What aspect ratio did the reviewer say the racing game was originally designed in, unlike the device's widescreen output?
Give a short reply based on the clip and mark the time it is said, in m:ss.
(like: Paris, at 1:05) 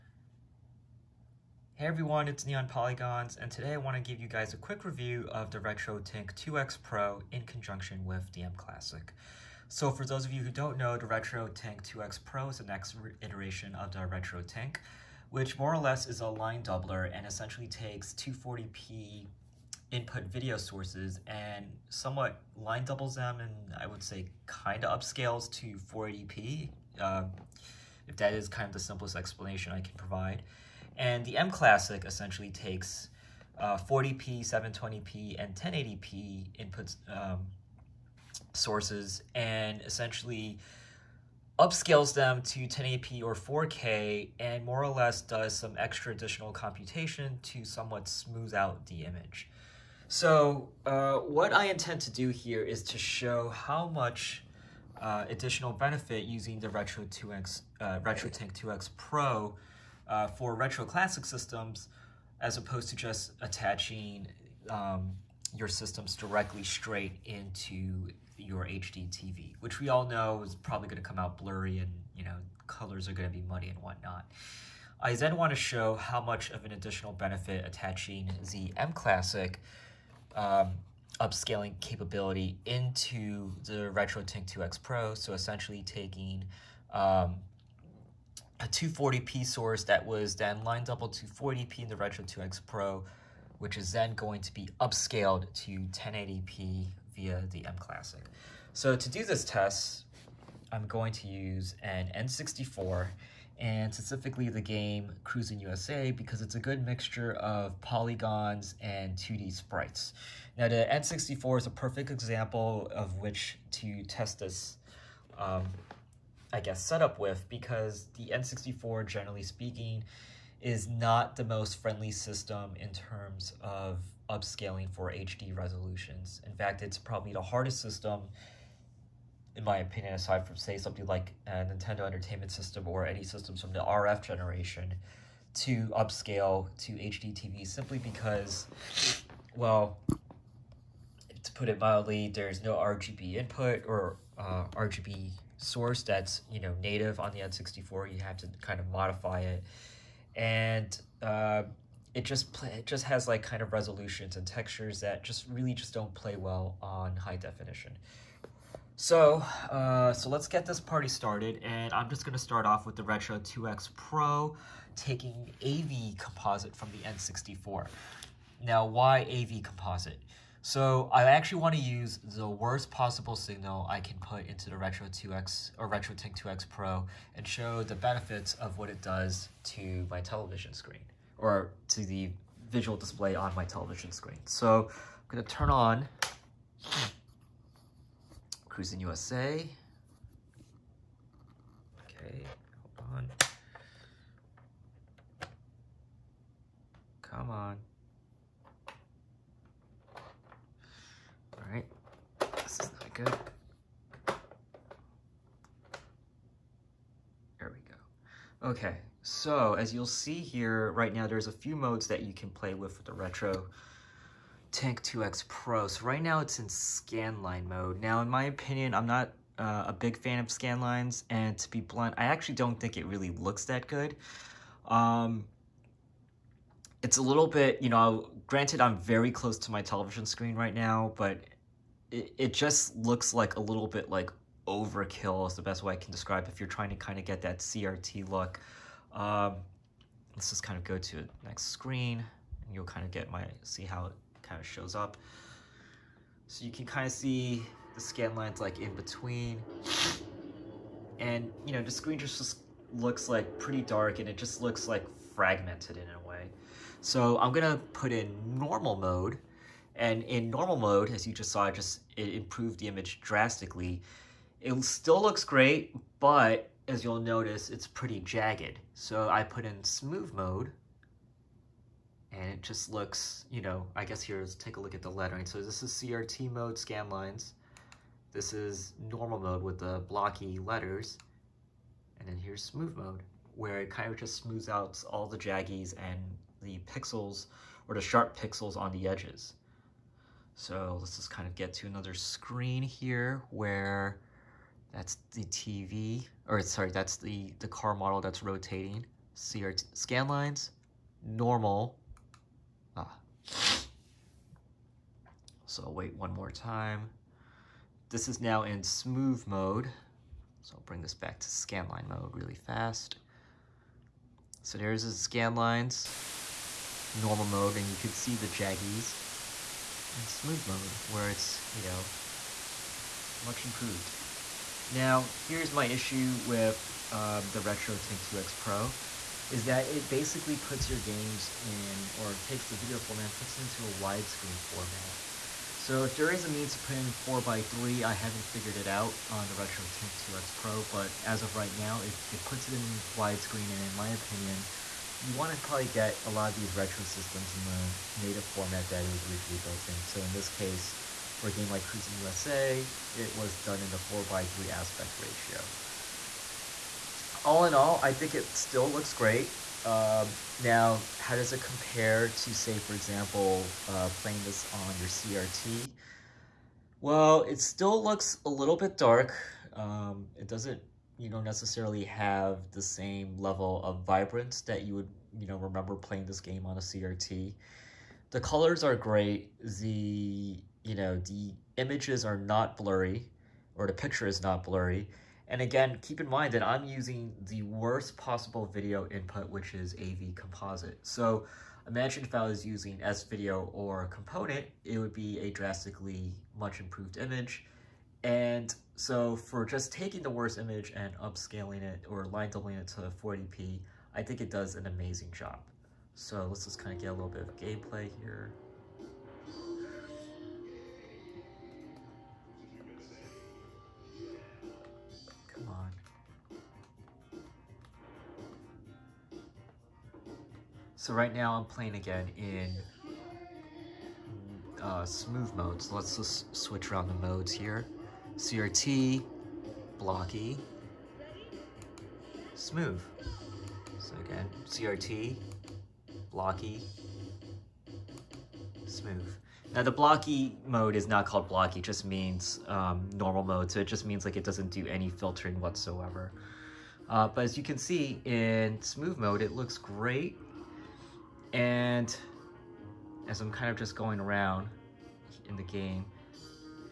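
4x3, at 5:53.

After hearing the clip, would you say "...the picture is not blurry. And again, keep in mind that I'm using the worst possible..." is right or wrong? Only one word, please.
right.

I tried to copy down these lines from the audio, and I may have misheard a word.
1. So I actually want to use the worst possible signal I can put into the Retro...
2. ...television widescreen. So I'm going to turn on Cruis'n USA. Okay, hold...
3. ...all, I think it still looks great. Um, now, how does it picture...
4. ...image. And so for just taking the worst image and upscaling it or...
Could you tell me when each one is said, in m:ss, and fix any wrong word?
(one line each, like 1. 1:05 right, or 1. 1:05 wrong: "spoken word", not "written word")
1. 2:50 right
2. 3:03 wrong: "screen", not "widescreen"
3. 5:57 wrong: "compare", not "picture"
4. 6:37 right.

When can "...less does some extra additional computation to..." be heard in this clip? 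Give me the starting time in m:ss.
0:44.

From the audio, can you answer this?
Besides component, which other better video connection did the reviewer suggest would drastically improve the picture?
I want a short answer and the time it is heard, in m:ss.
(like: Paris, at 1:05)
S-Video, at 6:33.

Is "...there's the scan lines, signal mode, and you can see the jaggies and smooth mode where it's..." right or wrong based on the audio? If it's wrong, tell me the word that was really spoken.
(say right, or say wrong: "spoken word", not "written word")
wrong: "normal", not "signal".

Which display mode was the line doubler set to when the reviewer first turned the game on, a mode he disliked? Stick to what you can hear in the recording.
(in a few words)
Scanline mode.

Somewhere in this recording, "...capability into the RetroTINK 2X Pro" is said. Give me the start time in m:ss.
1:21.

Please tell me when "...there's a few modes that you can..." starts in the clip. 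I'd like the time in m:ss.
3:31.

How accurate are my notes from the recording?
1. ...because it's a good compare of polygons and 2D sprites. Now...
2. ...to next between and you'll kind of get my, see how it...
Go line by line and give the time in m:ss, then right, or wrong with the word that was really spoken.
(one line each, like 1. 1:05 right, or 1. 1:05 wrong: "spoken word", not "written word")
1. 1:46 wrong: "mixture", not "compare"
2. 4:00 wrong: "screen", not "between".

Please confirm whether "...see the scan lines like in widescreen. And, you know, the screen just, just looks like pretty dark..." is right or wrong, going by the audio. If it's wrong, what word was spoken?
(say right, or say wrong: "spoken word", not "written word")
wrong: "between", not "widescreen".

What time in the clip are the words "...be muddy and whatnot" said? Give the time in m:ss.
1:13.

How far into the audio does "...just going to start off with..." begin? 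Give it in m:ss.
2:42.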